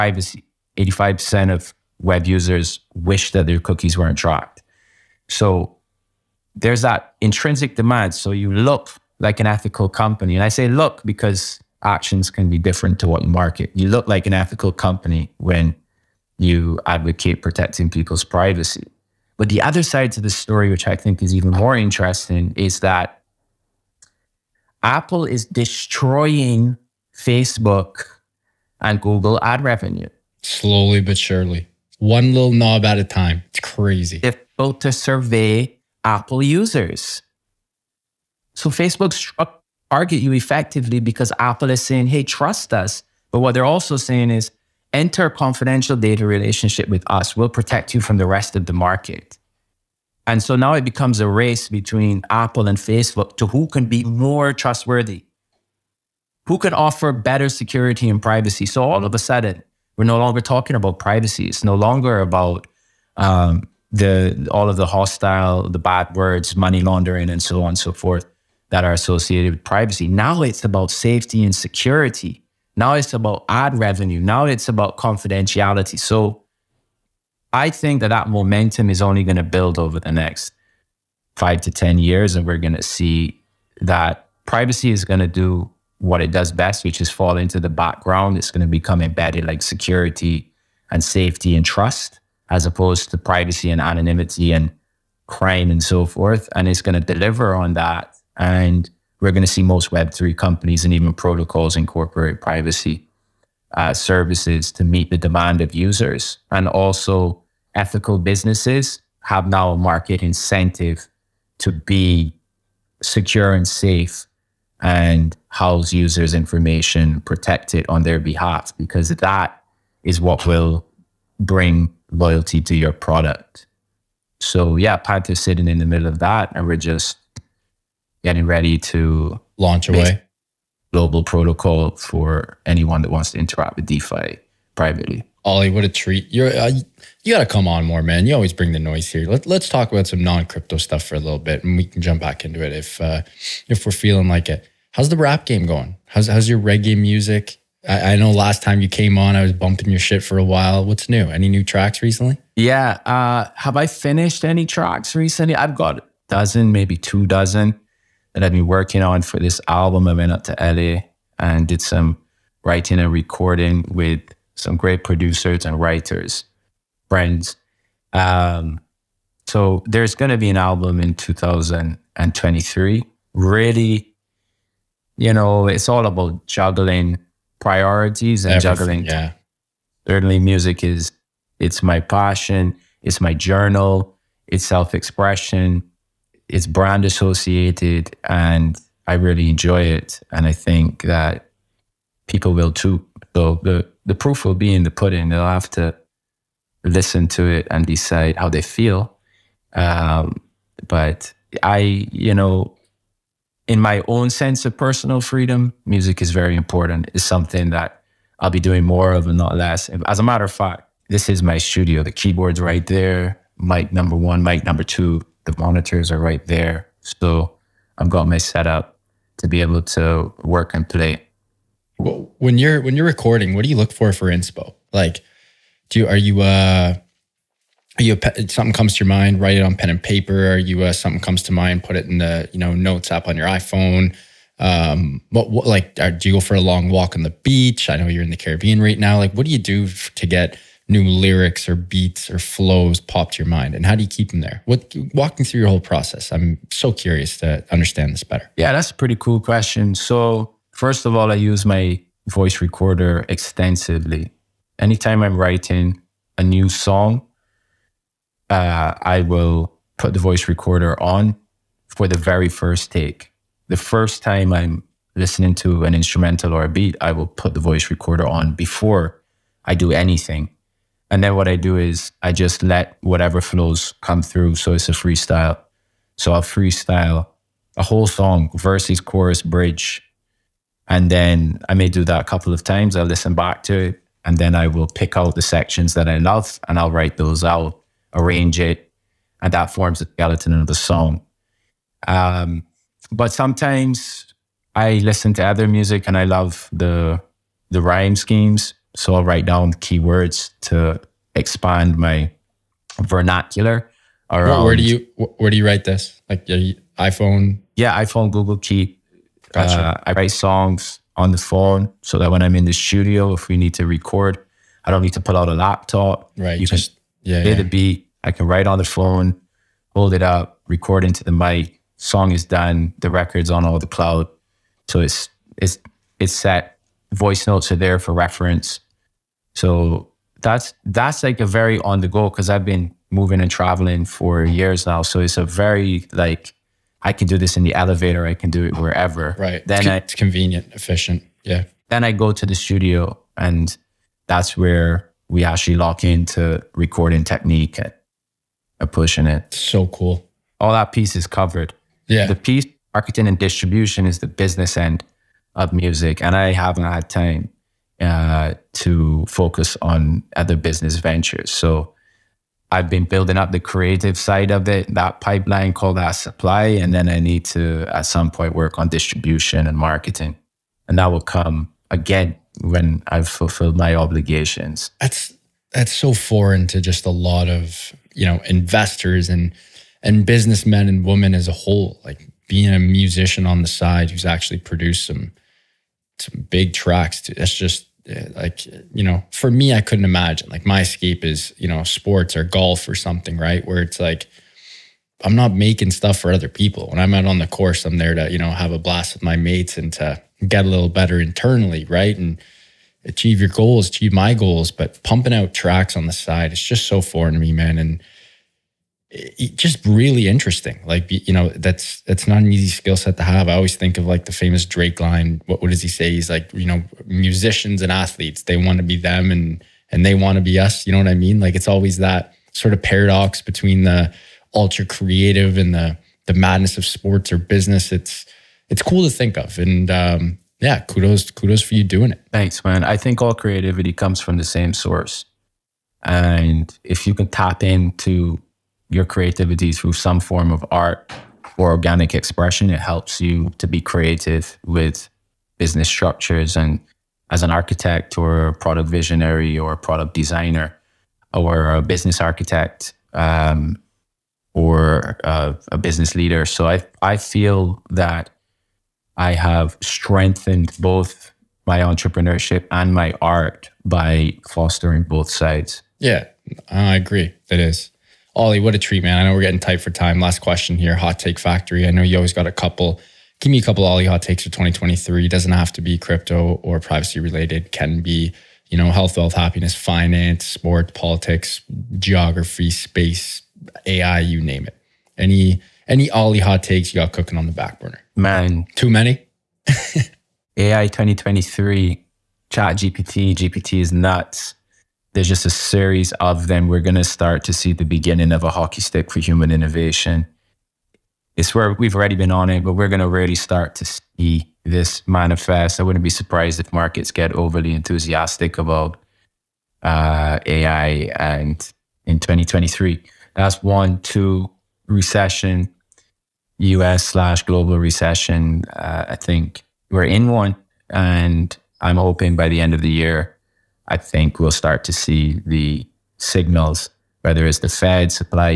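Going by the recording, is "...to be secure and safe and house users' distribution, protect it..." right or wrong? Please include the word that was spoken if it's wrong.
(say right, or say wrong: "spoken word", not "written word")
wrong: "information", not "distribution".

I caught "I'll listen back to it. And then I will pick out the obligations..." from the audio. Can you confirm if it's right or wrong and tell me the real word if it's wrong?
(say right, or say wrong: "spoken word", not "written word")
wrong: "sections", not "obligations".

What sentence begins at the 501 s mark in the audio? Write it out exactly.
It's where we've already been on it, but we're going to really start to see this manifest.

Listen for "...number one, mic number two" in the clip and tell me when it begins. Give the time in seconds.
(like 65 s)
213 s.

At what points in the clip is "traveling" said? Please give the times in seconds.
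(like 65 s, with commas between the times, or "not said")
333 s.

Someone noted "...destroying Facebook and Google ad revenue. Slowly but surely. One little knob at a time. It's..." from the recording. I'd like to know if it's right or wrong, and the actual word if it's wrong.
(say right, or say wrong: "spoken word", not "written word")
right.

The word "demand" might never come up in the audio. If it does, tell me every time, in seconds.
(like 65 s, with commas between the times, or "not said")
7 s, 105 s.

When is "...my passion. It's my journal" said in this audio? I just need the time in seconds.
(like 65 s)
181 s.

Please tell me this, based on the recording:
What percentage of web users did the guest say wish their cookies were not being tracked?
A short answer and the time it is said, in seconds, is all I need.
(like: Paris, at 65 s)
85%, at 0 s.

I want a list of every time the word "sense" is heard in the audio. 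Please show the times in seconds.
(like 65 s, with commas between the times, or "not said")
204 s.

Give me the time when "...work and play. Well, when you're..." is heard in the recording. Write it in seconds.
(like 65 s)
220 s.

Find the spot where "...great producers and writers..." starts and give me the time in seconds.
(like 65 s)
164 s.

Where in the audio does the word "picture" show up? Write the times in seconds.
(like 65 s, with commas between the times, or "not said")
not said.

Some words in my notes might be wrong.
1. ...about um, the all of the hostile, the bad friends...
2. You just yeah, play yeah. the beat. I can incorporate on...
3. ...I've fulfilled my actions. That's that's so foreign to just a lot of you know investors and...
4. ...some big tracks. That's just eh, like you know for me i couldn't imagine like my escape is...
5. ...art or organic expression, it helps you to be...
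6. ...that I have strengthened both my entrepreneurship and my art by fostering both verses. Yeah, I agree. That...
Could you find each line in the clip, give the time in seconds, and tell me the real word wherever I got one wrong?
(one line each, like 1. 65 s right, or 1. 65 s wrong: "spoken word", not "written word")
1. 62 s wrong: "words", not "friends"
2. 316 s wrong: "write", not "incorporate"
3. 373 s wrong: "obligations", not "actions"
4. 386 s right
5. 440 s right
6. 457 s wrong: "sides", not "verses".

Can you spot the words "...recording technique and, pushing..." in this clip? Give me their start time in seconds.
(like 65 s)
346 s.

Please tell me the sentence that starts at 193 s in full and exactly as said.
So the the proof will be in the pudding.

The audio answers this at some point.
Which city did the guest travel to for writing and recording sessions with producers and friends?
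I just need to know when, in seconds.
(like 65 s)
160 s.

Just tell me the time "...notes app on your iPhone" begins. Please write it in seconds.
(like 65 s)
232 s.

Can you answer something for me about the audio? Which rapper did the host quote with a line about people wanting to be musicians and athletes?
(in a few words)
Drake.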